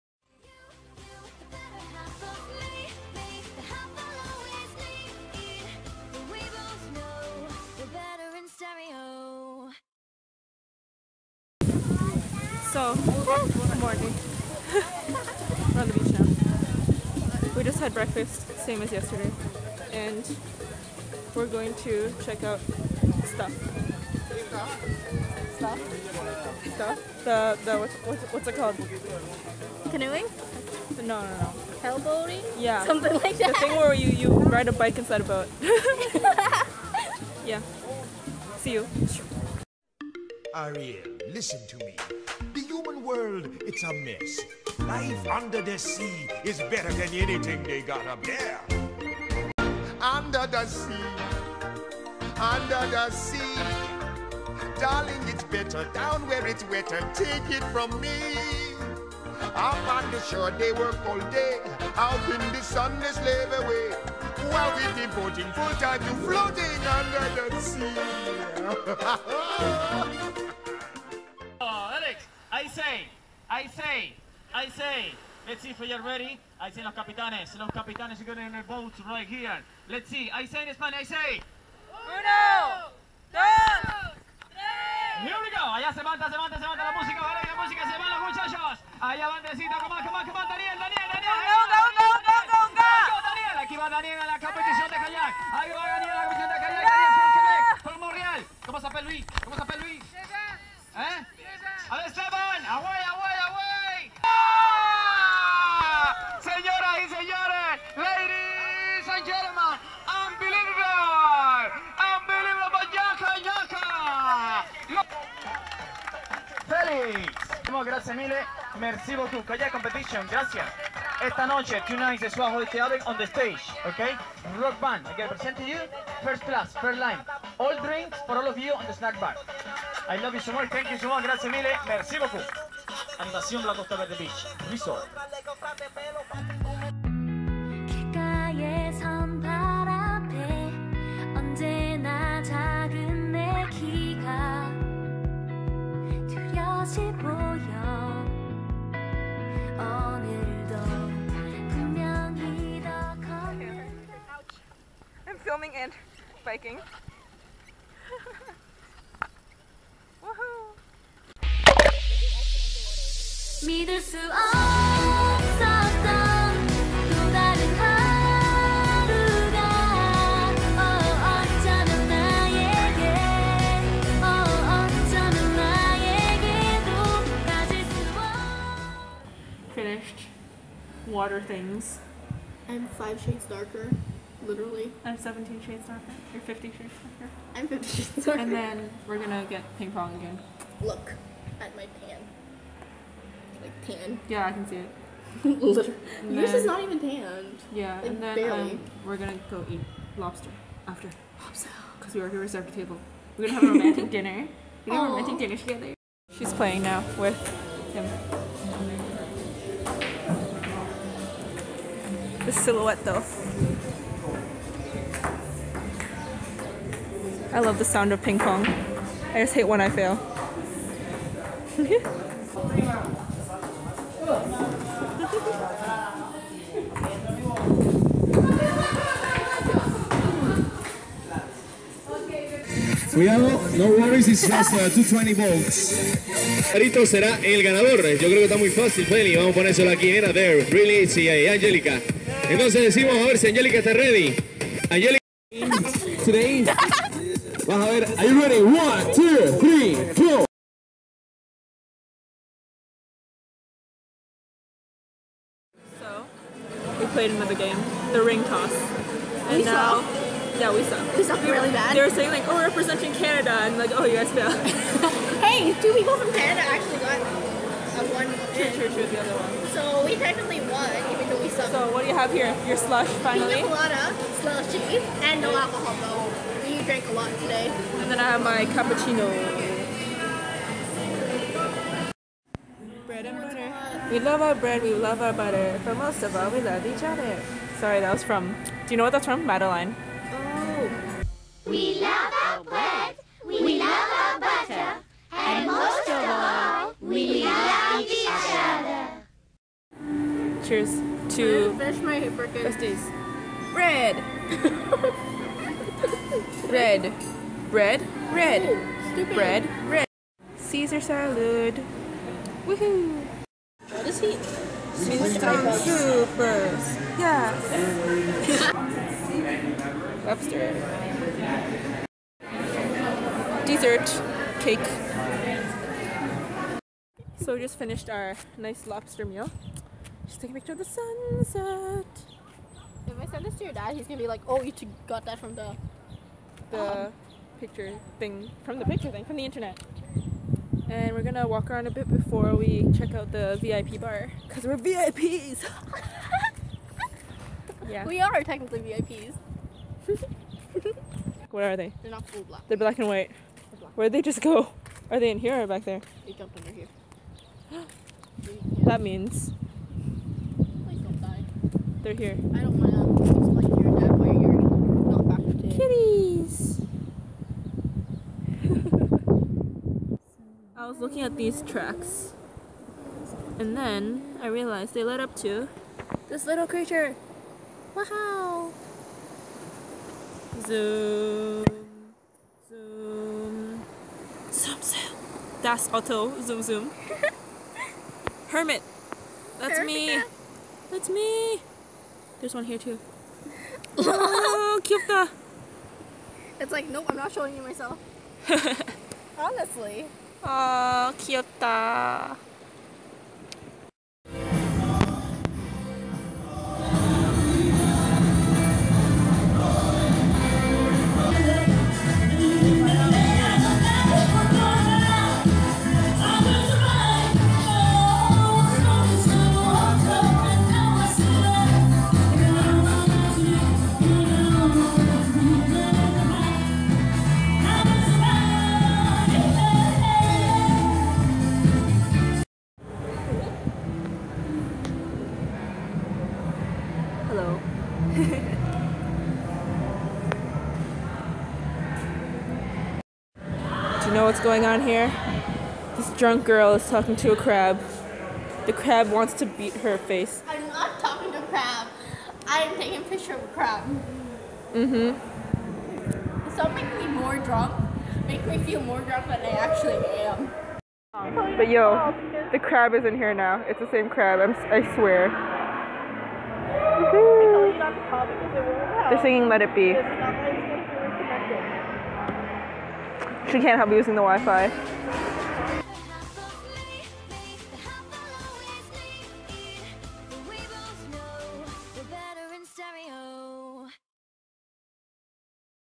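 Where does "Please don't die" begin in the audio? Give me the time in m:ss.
6:00.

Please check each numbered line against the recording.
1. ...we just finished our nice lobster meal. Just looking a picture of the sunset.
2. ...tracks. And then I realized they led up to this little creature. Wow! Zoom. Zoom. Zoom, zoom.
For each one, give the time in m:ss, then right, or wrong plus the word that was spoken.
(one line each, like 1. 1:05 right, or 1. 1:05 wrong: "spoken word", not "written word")
1. 5:27 wrong: "taking", not "looking"
2. 6:11 right.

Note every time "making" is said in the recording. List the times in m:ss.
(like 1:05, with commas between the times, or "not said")
7:36.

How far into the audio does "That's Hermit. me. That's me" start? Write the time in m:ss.
6:29.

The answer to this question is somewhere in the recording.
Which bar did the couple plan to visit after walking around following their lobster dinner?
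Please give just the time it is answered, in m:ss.
5:43.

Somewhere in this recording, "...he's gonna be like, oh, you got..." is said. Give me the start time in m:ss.
5:33.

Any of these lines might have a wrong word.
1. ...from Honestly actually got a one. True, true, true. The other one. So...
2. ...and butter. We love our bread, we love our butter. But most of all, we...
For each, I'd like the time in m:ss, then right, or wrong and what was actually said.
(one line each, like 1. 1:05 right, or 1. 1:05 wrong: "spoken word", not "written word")
1. 4:26 wrong: "Canada", not "Honestly"
2. 4:43 right.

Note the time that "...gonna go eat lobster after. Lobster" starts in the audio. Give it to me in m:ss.
3:19.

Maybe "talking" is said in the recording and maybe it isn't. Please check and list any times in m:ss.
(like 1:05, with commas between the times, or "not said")
7:26, 7:30.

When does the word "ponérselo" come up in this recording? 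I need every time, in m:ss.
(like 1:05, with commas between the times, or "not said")
3:59.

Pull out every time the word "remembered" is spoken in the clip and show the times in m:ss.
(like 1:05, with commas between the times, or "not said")
not said.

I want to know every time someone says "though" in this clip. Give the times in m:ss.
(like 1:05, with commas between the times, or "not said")
3:33, 4:31, 4:36.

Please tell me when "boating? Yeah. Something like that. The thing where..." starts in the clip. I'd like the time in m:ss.
0:31.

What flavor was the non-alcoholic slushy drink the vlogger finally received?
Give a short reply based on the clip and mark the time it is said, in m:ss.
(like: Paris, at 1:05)
Pina colada, at 4:33.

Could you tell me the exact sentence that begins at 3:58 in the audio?
Yo creo que está muy fácil, Feli.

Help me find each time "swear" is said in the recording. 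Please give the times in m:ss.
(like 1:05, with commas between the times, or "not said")
7:44.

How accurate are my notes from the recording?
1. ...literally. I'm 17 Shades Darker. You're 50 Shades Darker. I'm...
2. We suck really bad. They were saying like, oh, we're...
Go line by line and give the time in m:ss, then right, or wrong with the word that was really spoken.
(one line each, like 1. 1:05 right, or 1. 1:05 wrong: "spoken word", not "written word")
1. 3:04 right
2. 4:21 right.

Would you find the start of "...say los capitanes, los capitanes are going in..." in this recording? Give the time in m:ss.
1:16.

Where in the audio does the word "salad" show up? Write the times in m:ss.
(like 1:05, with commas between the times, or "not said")
5:11.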